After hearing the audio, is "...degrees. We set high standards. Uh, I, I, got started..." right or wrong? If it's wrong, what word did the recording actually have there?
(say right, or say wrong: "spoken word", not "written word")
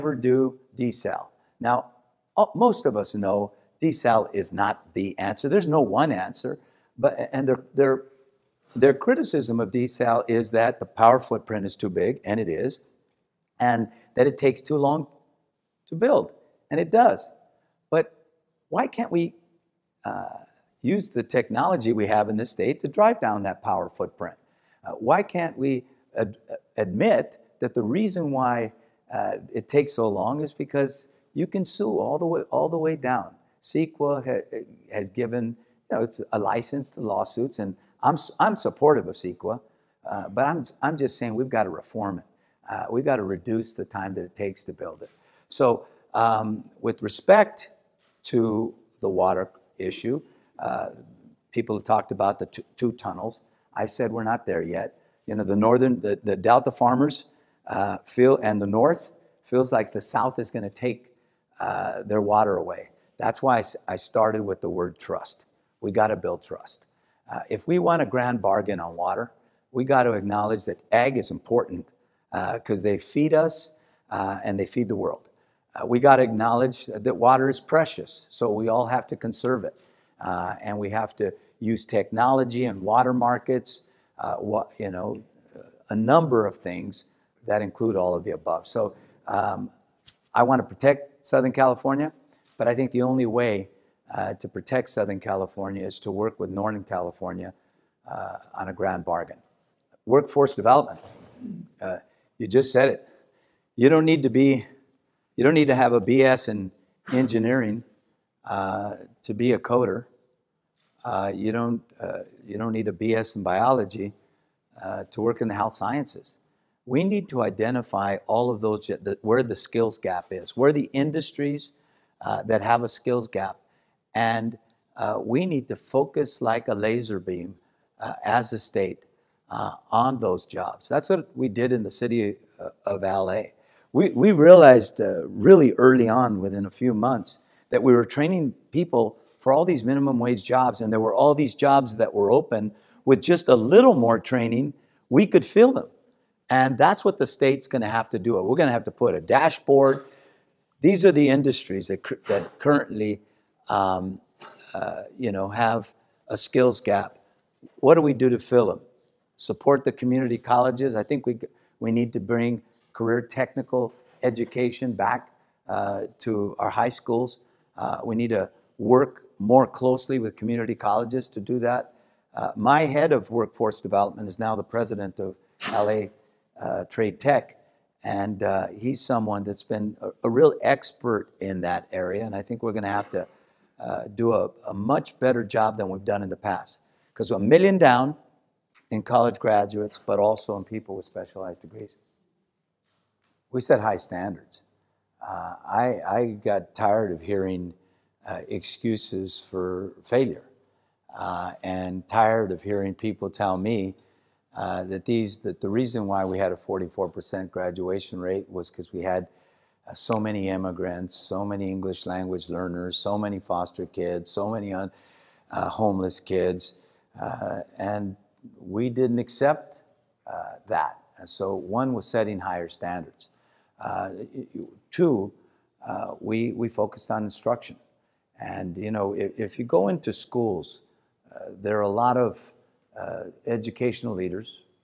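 wrong: "tired", not "started".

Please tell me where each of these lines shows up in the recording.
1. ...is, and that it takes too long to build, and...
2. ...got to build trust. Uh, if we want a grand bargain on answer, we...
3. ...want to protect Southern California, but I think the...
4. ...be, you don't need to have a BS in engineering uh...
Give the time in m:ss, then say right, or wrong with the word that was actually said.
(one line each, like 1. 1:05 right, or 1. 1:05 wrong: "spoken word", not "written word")
1. 0:12 right
2. 1:05 wrong: "water", not "answer"
3. 1:30 right
4. 1:44 right.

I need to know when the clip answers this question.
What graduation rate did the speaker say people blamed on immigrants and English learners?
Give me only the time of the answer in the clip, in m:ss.
3:26.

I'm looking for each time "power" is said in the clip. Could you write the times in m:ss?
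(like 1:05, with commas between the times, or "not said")
0:10, 0:23.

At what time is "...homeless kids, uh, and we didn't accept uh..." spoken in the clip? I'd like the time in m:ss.
3:35.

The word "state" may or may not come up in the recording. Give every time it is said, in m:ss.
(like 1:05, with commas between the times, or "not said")
0:22, 2:08, 2:27.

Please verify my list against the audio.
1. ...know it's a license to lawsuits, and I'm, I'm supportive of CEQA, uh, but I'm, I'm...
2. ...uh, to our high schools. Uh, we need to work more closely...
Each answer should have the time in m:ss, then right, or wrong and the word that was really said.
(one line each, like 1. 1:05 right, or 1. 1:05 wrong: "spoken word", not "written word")
1. 0:35 right
2. 2:45 right.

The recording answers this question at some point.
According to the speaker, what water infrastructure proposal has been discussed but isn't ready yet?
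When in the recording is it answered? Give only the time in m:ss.
0:52.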